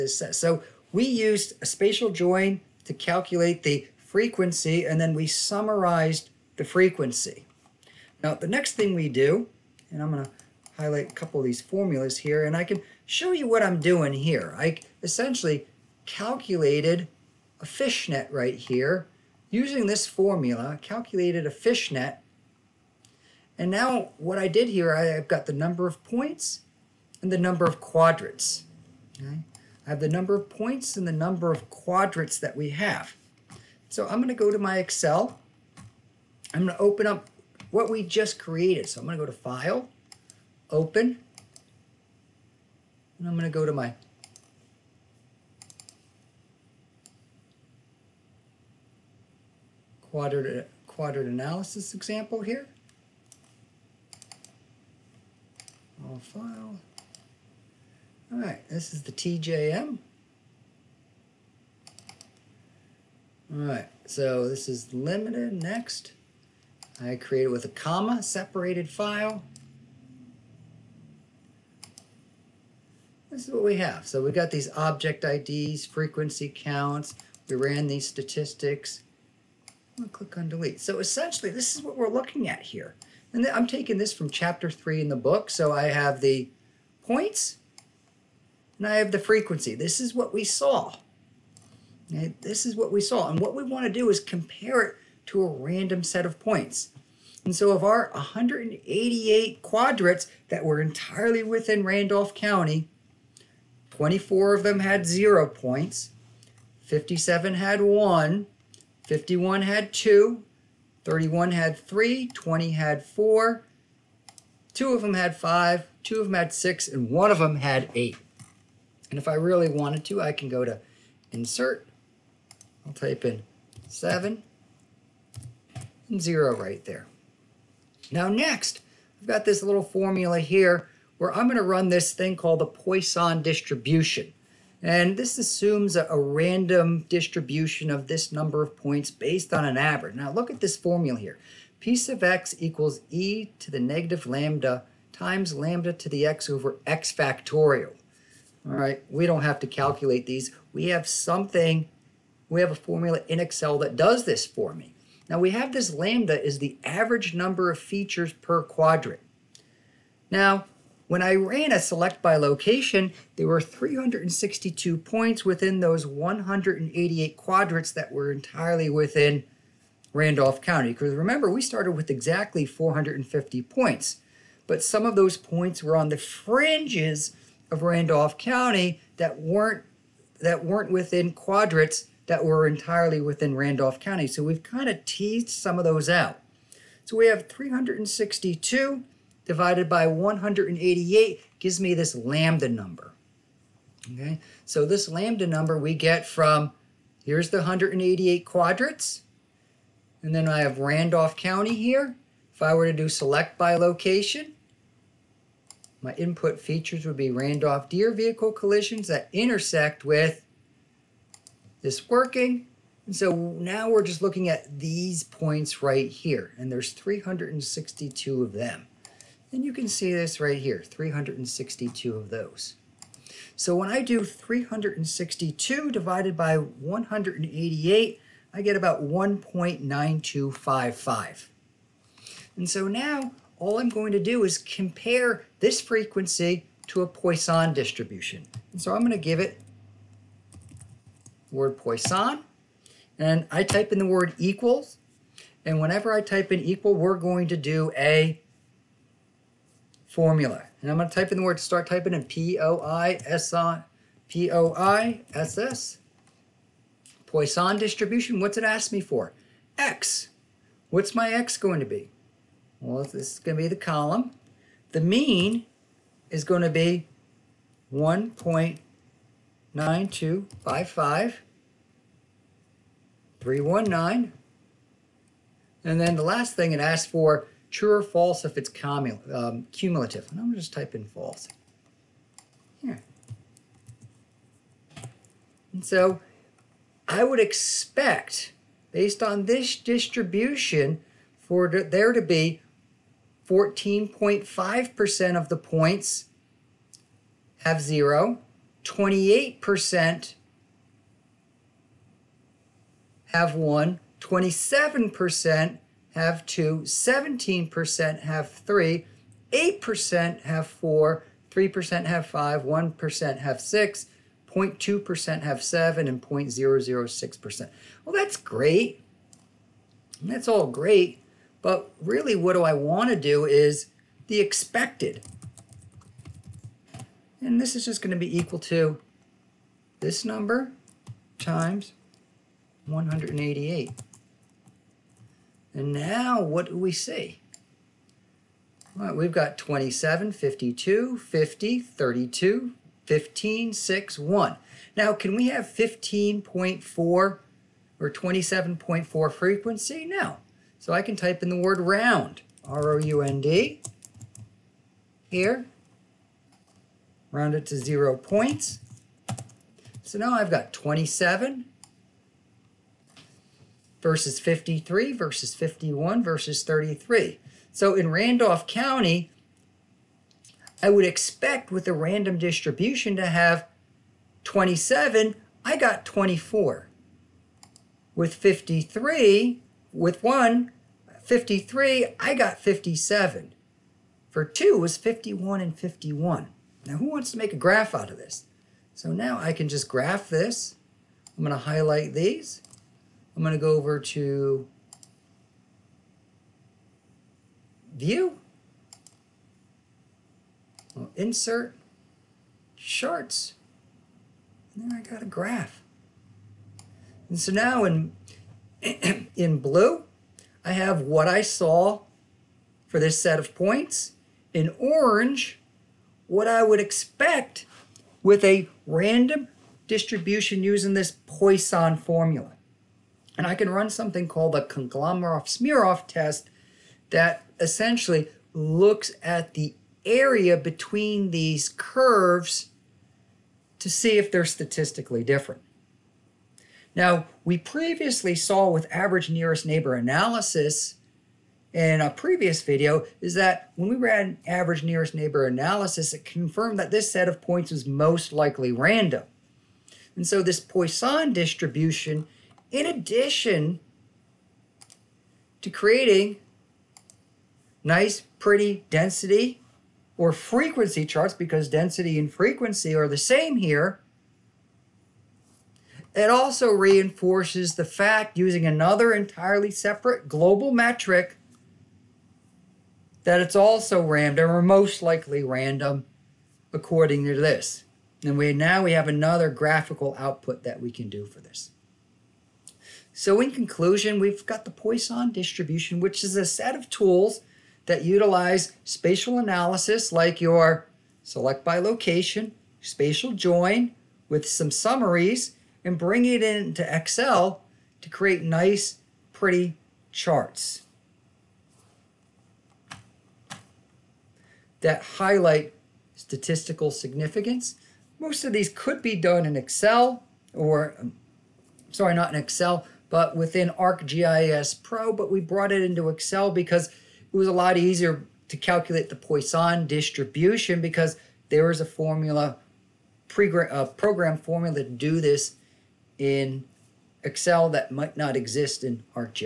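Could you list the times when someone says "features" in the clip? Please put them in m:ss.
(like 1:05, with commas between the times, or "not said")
2:37, 3:26.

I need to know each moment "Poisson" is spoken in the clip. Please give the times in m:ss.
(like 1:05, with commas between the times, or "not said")
2:12, 3:57, 4:01, 4:17, 7:01, 7:30, 8:04, 8:39.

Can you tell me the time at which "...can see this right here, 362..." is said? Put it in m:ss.
3:39.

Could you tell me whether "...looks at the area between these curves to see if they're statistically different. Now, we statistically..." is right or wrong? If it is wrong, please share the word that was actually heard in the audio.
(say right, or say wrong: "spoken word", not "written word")
wrong: "previously", not "statistically".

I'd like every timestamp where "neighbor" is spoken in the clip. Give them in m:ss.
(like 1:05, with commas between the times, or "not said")
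7:19, 7:25.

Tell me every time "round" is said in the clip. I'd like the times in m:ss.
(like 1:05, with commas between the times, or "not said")
5:51, 5:57.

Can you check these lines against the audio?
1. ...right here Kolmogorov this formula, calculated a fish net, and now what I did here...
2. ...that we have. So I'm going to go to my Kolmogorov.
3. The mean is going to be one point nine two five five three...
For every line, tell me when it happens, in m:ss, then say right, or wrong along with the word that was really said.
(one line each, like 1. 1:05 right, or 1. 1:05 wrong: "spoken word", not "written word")
1. 0:18 wrong: "Using", not "Kolmogorov"
2. 0:32 wrong: "Excel", not "Kolmogorov"
3. 4:24 right.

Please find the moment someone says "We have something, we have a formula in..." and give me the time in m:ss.
2:30.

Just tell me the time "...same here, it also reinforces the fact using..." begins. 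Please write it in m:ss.
7:43.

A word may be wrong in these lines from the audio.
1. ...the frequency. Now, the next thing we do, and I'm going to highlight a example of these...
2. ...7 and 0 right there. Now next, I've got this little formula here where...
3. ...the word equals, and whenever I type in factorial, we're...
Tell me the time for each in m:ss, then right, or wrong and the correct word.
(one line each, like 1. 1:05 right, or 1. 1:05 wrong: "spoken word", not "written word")
1. 0:06 wrong: "couple", not "example"
2. 2:03 right
3. 4:03 wrong: "equal", not "factorial".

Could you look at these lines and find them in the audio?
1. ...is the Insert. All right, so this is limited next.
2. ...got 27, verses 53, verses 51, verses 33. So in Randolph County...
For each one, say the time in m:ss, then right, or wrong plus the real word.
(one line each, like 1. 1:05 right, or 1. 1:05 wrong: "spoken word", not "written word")
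1. 0:58 wrong: "TJM", not "Insert"
2. 6:00 right.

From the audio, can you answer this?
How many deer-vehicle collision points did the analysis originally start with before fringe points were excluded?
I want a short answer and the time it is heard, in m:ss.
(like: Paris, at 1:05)
450, at 2:52.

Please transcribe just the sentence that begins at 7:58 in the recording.
And we now we have another graphical output that we can do for this.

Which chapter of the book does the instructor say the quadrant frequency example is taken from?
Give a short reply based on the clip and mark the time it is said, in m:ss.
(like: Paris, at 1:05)
Chapter 3, at 1:24.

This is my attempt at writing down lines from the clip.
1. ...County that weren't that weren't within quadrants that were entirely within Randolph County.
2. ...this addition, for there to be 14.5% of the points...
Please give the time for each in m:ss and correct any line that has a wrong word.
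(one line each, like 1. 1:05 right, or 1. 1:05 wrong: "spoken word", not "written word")
1. 2:58 right
2. 4:49 wrong: "distribution", not "addition".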